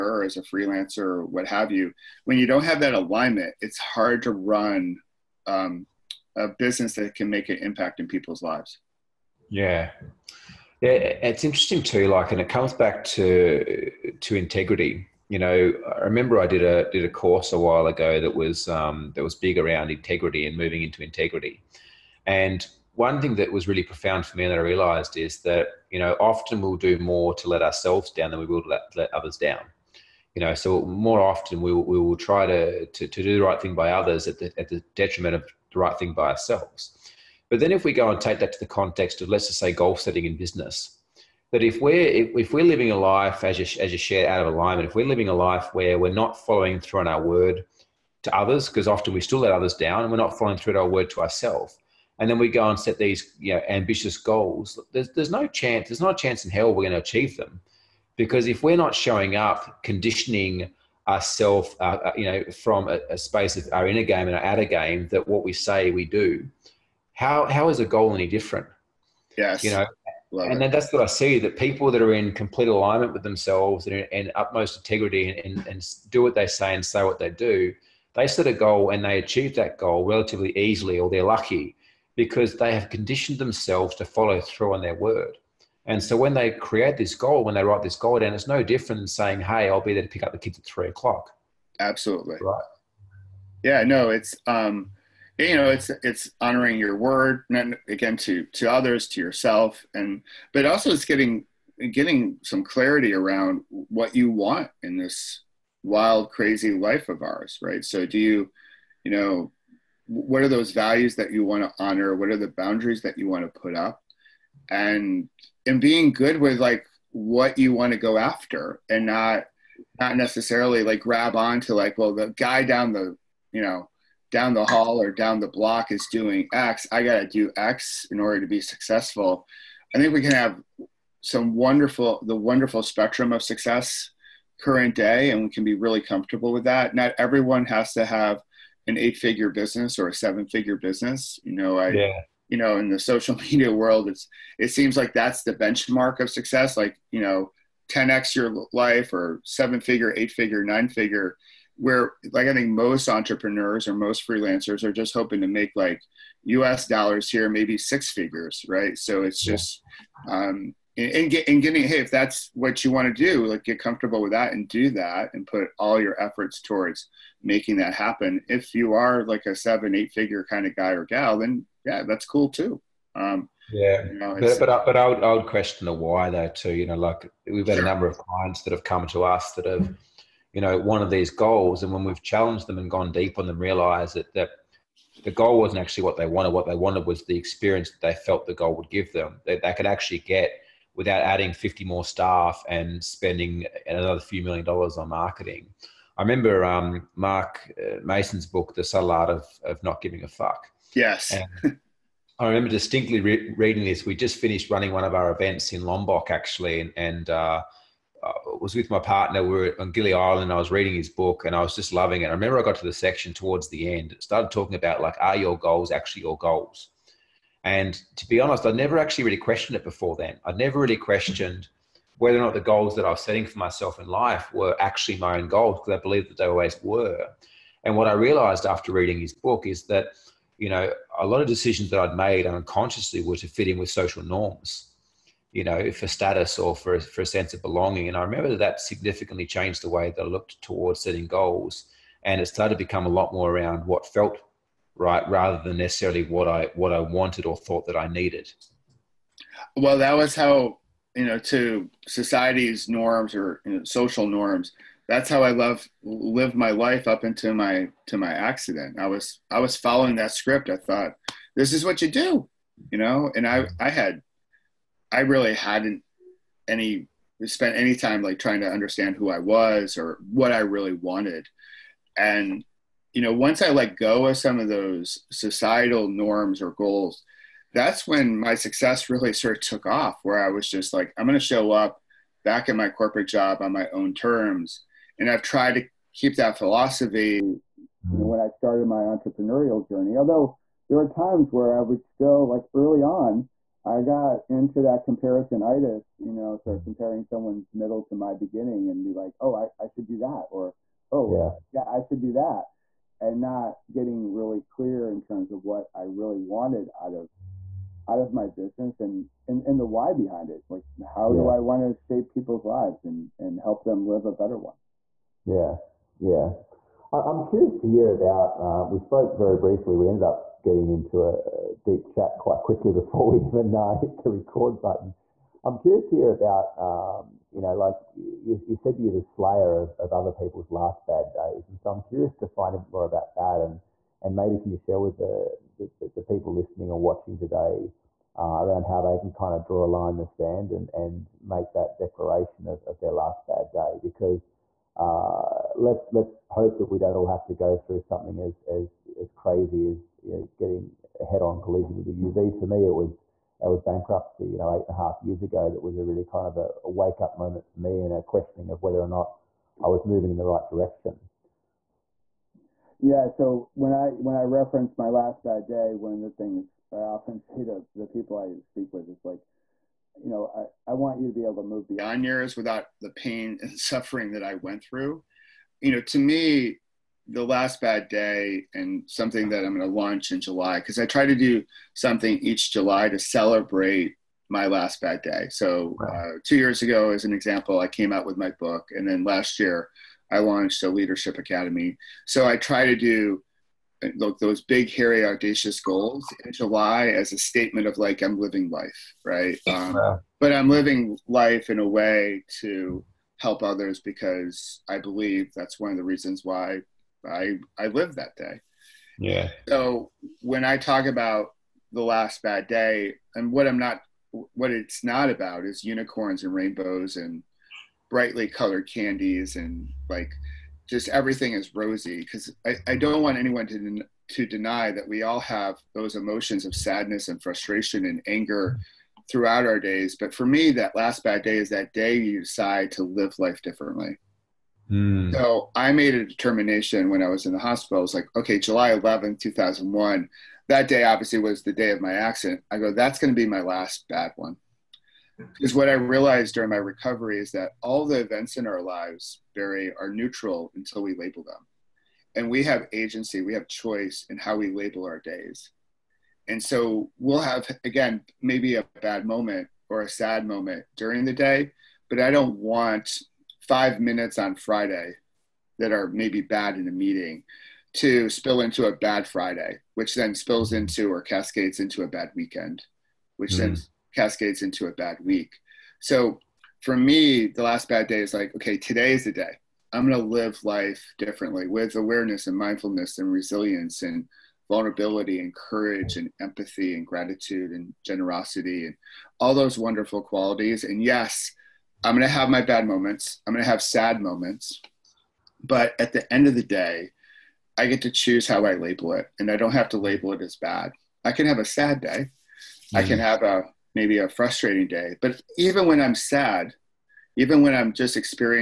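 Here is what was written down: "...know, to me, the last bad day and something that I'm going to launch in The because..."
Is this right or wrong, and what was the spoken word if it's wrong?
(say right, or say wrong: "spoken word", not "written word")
wrong: "July", not "The".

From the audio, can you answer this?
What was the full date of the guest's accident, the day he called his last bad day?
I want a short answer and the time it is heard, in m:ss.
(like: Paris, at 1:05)
July 11, 2001, at 7:18.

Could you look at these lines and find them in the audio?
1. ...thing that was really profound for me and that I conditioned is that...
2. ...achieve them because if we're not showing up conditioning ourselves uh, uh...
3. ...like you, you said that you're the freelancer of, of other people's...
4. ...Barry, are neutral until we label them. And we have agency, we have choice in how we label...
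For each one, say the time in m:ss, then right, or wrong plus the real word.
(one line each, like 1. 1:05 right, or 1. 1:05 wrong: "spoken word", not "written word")
1. 0:23 wrong: "realized", not "conditioned"
2. 0:56 right
3. 5:27 wrong: "slayer", not "freelancer"
4. 7:29 right.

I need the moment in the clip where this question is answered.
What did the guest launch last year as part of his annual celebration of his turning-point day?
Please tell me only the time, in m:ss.
6:30.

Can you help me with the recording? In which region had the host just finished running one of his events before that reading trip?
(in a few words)
Lombok.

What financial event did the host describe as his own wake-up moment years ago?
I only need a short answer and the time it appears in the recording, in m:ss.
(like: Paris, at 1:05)
bankruptcy, at 5:53.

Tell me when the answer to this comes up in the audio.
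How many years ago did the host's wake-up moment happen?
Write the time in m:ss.
5:54.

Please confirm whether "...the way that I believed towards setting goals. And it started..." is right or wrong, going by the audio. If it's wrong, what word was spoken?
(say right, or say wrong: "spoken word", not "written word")
wrong: "looked", not "believed".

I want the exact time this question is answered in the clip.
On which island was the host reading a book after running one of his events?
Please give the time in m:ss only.
3:29.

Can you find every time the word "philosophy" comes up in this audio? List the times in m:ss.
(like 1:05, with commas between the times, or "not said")
4:46.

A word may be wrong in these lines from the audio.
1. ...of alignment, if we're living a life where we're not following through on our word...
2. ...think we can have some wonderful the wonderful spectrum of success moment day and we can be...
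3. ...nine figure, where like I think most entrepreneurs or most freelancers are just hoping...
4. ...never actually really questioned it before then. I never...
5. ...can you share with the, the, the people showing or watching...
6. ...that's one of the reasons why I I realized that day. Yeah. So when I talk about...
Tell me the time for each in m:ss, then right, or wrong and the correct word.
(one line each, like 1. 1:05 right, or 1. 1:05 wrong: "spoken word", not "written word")
1. 0:44 right
2. 2:09 wrong: "current", not "moment"
3. 2:30 right
4. 3:38 right
5. 5:34 wrong: "listening", not "showing"
6. 6:45 wrong: "lived", not "realized".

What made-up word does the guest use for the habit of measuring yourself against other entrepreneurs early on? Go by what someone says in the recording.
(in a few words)
comparisonitis.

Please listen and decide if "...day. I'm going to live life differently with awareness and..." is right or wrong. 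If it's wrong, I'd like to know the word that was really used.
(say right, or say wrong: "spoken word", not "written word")
right.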